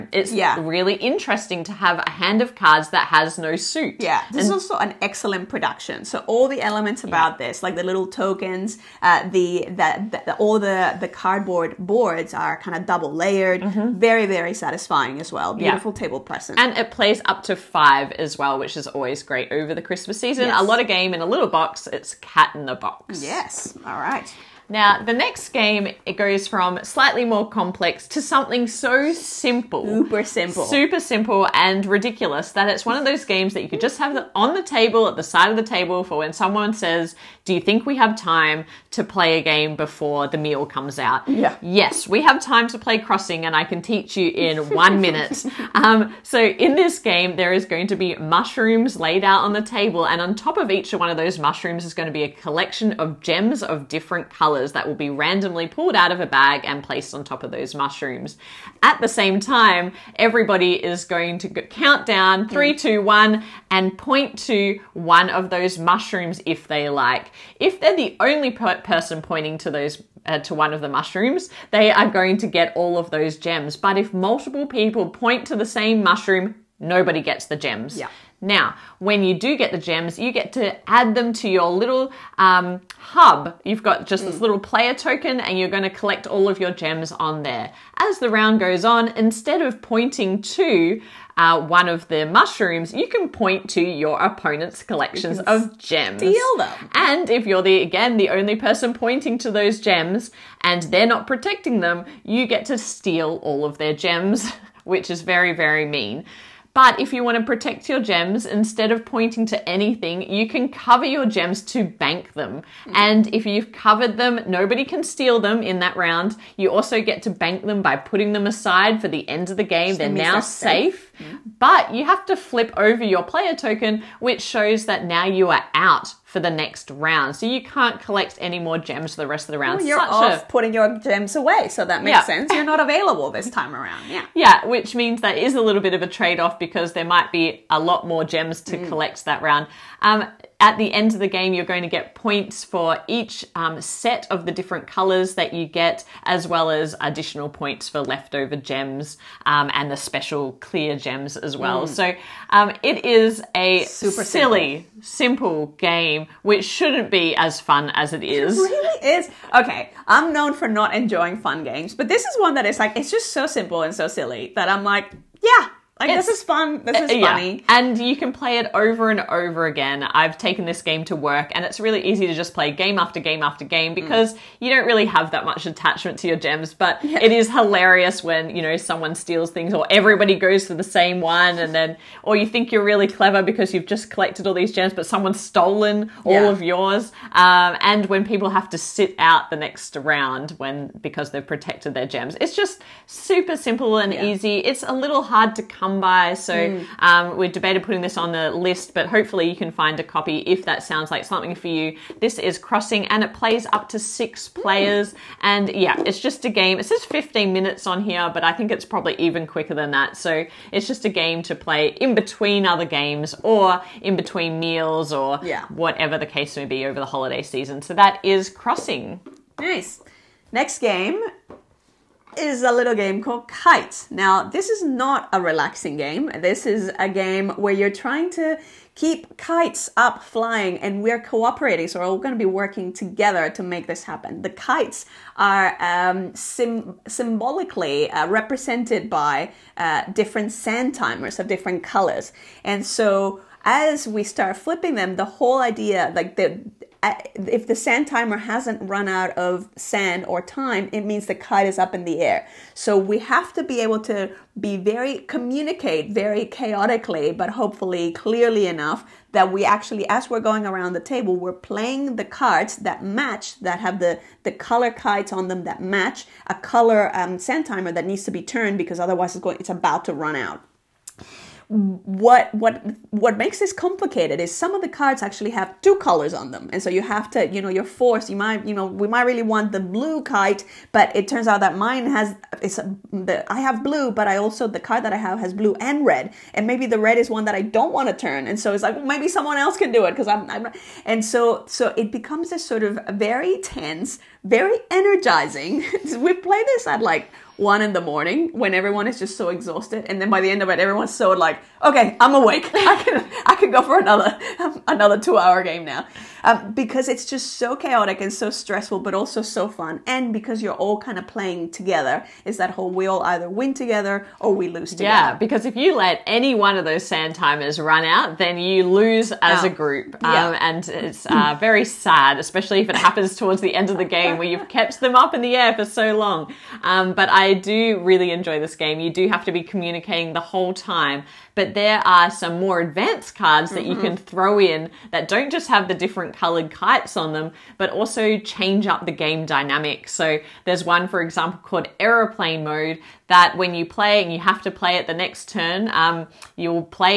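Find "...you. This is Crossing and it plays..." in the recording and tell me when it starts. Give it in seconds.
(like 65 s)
201 s.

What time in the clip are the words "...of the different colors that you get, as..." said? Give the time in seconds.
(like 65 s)
144 s.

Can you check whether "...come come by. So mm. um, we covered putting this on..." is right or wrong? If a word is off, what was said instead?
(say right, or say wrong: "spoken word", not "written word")
wrong: "debated", not "covered".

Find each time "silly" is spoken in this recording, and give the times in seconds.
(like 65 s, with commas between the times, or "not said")
154 s, 164 s.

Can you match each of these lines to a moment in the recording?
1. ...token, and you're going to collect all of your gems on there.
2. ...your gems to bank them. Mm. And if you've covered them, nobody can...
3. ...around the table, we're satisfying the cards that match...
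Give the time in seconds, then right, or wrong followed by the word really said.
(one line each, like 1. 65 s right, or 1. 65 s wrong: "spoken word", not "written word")
1. 84 s right
2. 111 s right
3. 260 s wrong: "playing", not "satisfying".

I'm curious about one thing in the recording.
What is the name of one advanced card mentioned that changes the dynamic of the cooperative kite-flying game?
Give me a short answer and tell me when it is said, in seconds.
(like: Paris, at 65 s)
Aeroplane mode, at 342 s.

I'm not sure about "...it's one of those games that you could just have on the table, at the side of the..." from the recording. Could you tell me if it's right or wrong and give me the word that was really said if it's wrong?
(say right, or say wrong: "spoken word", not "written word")
right.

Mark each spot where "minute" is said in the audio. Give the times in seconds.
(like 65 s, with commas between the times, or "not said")
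45 s, 207 s.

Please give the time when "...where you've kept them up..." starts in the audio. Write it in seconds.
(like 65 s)
324 s.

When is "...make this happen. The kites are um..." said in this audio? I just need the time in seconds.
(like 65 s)
233 s.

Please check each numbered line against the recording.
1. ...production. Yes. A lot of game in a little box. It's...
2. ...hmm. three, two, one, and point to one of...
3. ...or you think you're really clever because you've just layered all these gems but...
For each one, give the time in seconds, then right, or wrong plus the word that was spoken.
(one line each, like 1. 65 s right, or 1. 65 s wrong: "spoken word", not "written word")
1. 20 s wrong: "season", not "production"
2. 62 s right
3. 182 s wrong: "collected", not "layered".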